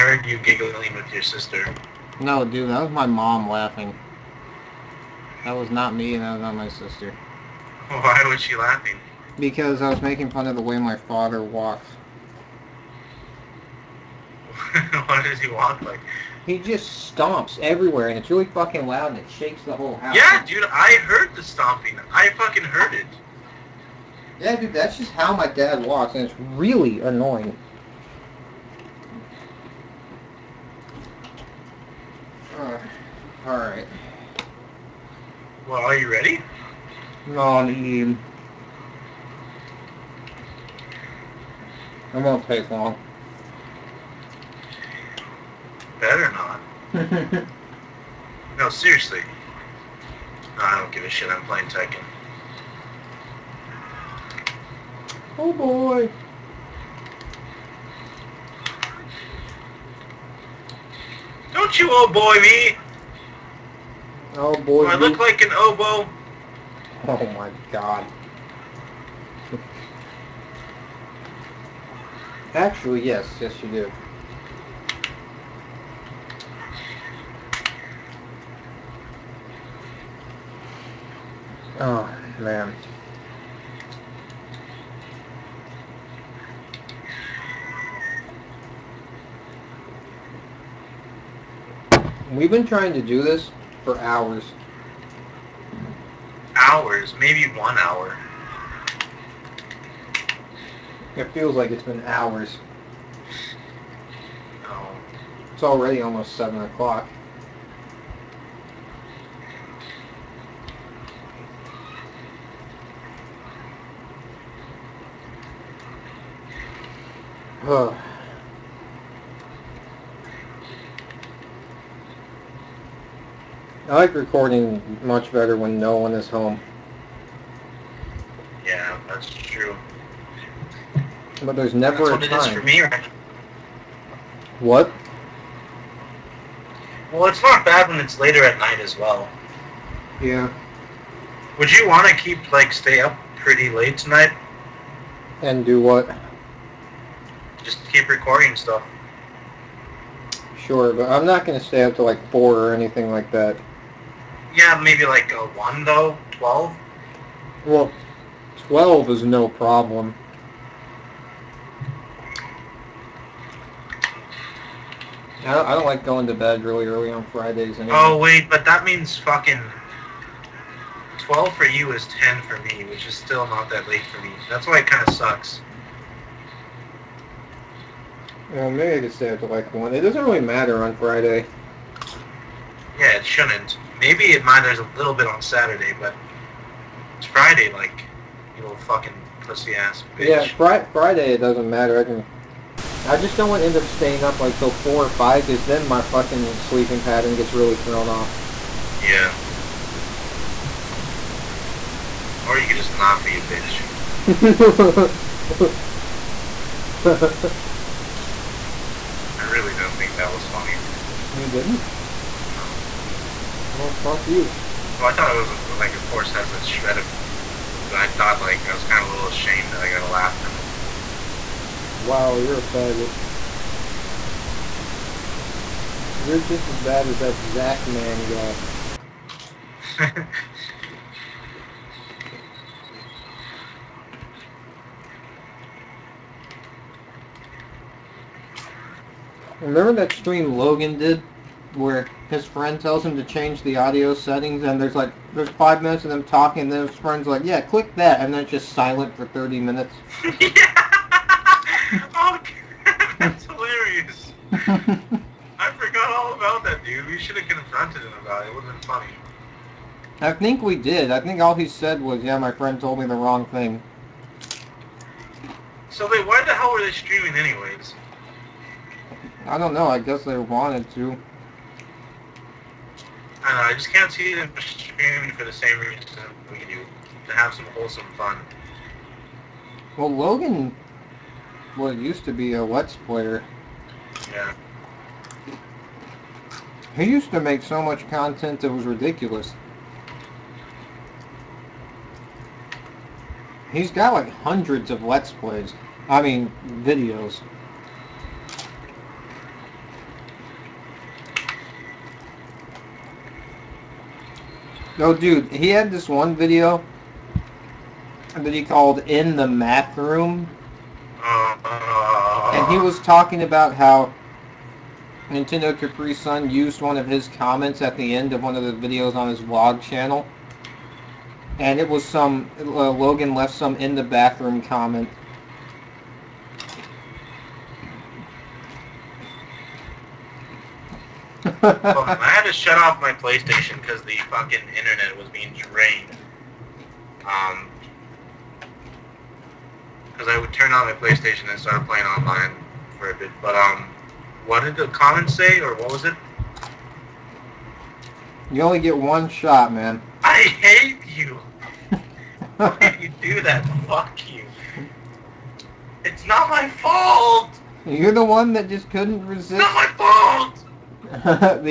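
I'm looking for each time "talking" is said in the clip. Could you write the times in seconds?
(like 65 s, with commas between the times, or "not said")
246 s, 312 s.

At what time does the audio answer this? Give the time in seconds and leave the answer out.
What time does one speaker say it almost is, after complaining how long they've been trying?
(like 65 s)
106 s.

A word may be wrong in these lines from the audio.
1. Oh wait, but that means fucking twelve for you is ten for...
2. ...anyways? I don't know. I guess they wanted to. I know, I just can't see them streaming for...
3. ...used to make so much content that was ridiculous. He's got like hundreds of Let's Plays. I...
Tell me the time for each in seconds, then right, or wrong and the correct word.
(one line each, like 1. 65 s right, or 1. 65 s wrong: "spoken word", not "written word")
1. 167 s right
2. 267 s right
3. 287 s right.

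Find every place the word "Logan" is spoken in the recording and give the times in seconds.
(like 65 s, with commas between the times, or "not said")
240 s, 280 s, 322 s.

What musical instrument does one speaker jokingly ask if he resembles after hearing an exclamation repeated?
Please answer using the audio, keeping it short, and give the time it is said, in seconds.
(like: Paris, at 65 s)
Oboe, at 65 s.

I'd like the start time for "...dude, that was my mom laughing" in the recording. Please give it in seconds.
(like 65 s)
2 s.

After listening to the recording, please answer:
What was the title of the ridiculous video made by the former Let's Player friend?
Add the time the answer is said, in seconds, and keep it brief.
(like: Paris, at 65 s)
In the Math Room, at 309 s.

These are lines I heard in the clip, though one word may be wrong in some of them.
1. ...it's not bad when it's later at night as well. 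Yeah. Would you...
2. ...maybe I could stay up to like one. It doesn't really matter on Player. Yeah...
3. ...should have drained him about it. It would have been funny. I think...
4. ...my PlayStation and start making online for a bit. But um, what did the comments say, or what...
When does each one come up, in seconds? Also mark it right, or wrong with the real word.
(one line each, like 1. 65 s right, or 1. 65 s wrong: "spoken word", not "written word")
1. 137 s right
2. 178 s wrong: "Friday", not "Player"
3. 257 s wrong: "confronted", not "drained"
4. 340 s wrong: "playing", not "making".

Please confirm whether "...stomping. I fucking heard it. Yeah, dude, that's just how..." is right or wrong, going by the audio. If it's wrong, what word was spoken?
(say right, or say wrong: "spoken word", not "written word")
right.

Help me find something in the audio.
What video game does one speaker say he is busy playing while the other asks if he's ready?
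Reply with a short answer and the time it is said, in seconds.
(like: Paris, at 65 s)
Tekken, at 51 s.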